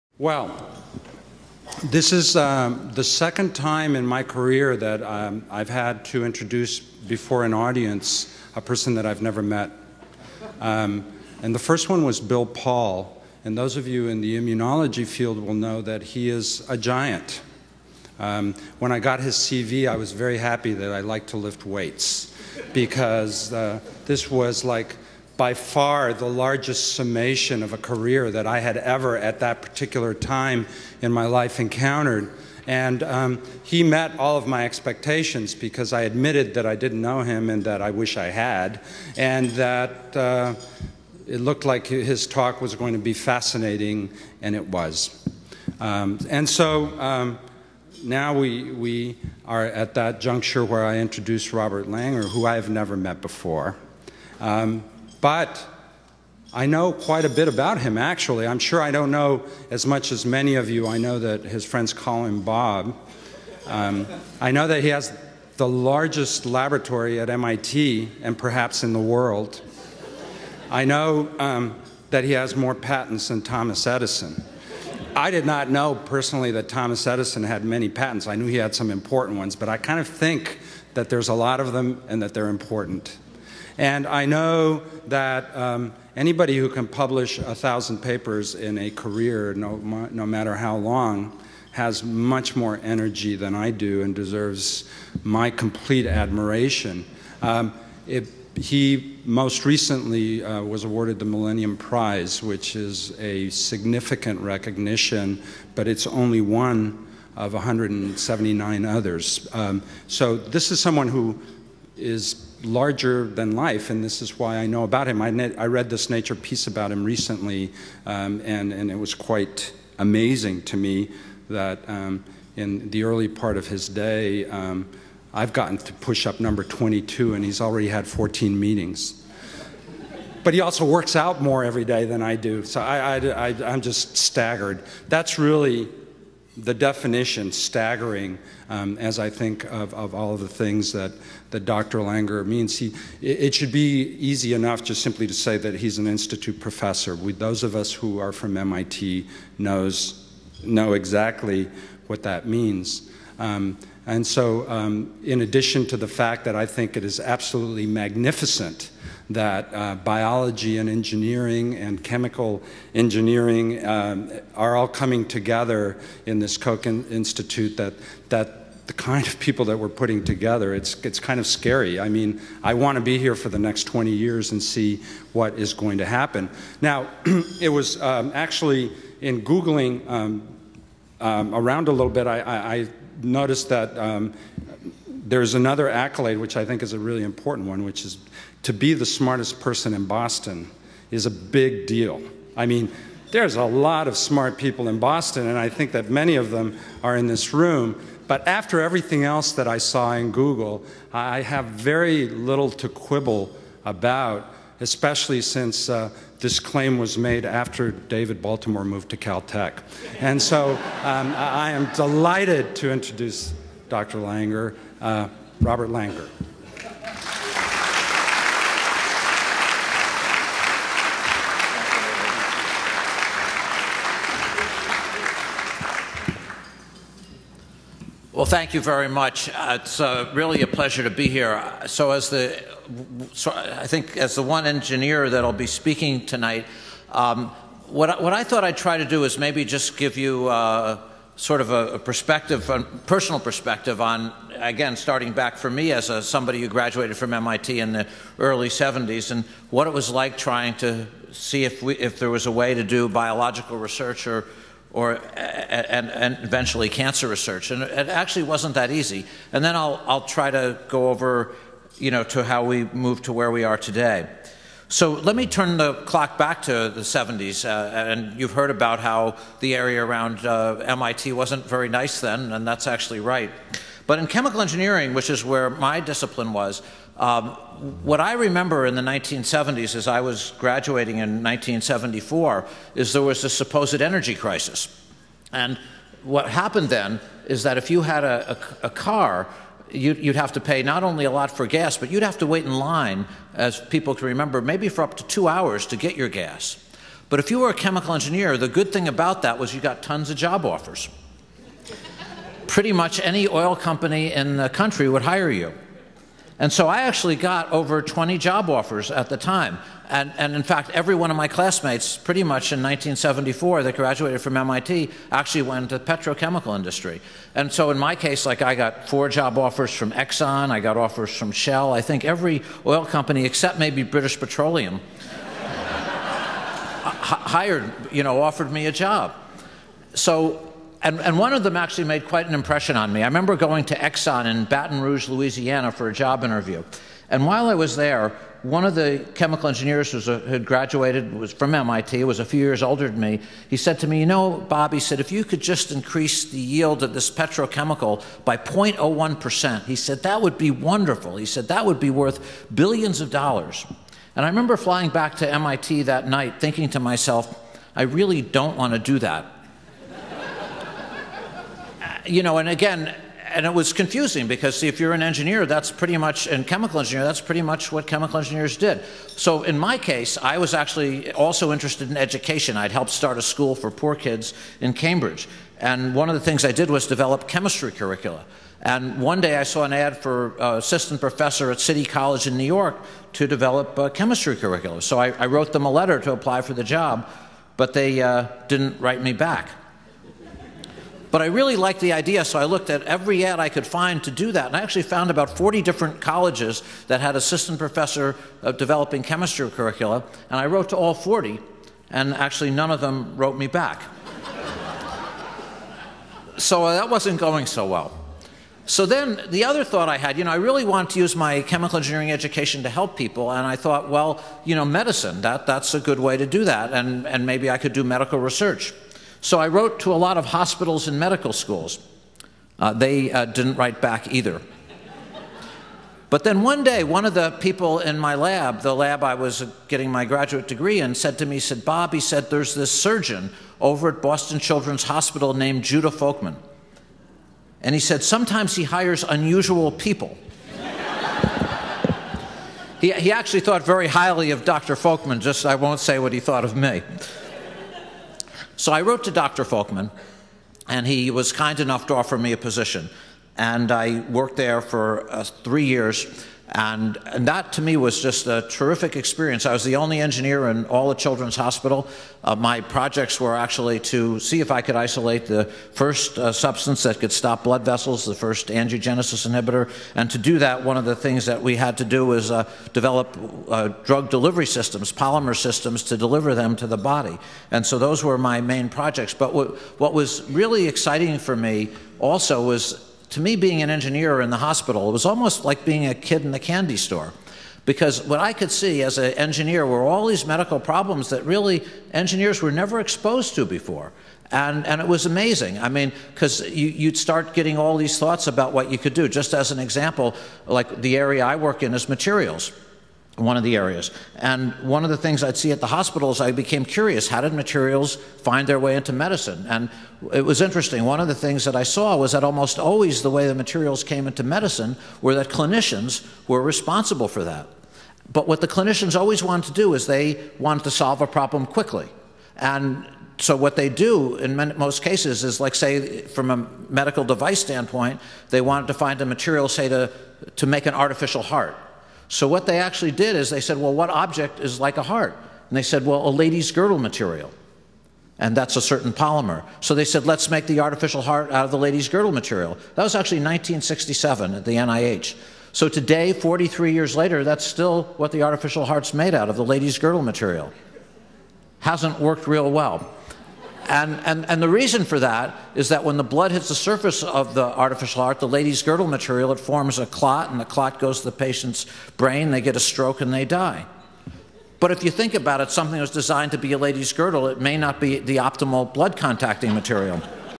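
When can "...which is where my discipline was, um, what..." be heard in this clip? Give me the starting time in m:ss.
4:35.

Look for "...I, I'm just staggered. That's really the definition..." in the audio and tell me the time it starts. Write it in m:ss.
2:13.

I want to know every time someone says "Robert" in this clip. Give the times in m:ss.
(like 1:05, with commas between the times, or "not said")
0:51, 3:35.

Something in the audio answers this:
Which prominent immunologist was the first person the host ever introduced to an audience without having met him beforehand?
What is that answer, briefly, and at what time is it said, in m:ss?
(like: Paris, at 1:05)
Bill Paul, at 0:12.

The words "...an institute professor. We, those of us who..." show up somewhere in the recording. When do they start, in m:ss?
2:25.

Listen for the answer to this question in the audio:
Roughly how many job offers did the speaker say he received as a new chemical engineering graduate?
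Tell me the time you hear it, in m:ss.
5:07.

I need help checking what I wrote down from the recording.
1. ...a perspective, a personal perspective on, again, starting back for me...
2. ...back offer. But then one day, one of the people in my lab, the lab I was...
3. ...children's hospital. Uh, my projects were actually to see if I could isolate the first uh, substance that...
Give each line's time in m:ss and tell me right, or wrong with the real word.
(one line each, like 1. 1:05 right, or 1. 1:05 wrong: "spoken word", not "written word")
1. 4:01 right
2. 7:03 wrong: "either", not "offer"
3. 7:41 right.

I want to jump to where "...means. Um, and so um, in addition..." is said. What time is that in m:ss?
2:32.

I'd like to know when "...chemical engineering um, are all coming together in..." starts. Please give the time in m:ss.
2:42.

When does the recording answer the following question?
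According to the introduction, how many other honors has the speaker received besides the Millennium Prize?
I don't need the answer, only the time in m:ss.
1:47.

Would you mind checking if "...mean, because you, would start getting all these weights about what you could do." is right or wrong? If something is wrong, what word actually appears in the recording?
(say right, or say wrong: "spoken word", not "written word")
wrong: "thoughts", not "weights".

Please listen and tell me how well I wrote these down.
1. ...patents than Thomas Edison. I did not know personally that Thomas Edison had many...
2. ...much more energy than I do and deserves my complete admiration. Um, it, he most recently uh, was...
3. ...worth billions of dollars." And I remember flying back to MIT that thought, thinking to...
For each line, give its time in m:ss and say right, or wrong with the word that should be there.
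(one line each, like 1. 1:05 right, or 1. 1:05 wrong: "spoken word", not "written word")
1. 1:12 right
2. 1:32 right
3. 5:52 wrong: "night", not "thought".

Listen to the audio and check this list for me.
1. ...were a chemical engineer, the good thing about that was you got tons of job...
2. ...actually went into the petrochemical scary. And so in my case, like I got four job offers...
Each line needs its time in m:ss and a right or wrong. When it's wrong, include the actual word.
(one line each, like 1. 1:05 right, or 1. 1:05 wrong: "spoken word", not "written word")
1. 4:57 right
2. 5:15 wrong: "industry", not "scary".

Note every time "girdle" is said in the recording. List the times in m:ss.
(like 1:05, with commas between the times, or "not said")
8:56, 9:02, 9:09, 9:18, 9:27.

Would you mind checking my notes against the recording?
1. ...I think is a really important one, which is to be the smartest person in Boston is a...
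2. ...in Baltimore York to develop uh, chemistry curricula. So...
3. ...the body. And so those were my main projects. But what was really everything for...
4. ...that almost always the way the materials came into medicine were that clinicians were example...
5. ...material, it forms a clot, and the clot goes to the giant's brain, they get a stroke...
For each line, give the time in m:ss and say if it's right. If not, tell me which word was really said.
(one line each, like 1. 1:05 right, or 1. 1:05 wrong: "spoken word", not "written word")
1. 3:06 right
2. 6:22 wrong: "New", not "Baltimore"
3. 7:56 wrong: "exciting", not "everything"
4. 8:32 wrong: "responsible", not "example"
5. 9:19 wrong: "patient", not "giant".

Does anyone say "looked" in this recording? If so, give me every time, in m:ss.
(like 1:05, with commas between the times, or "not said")
0:41, 6:32.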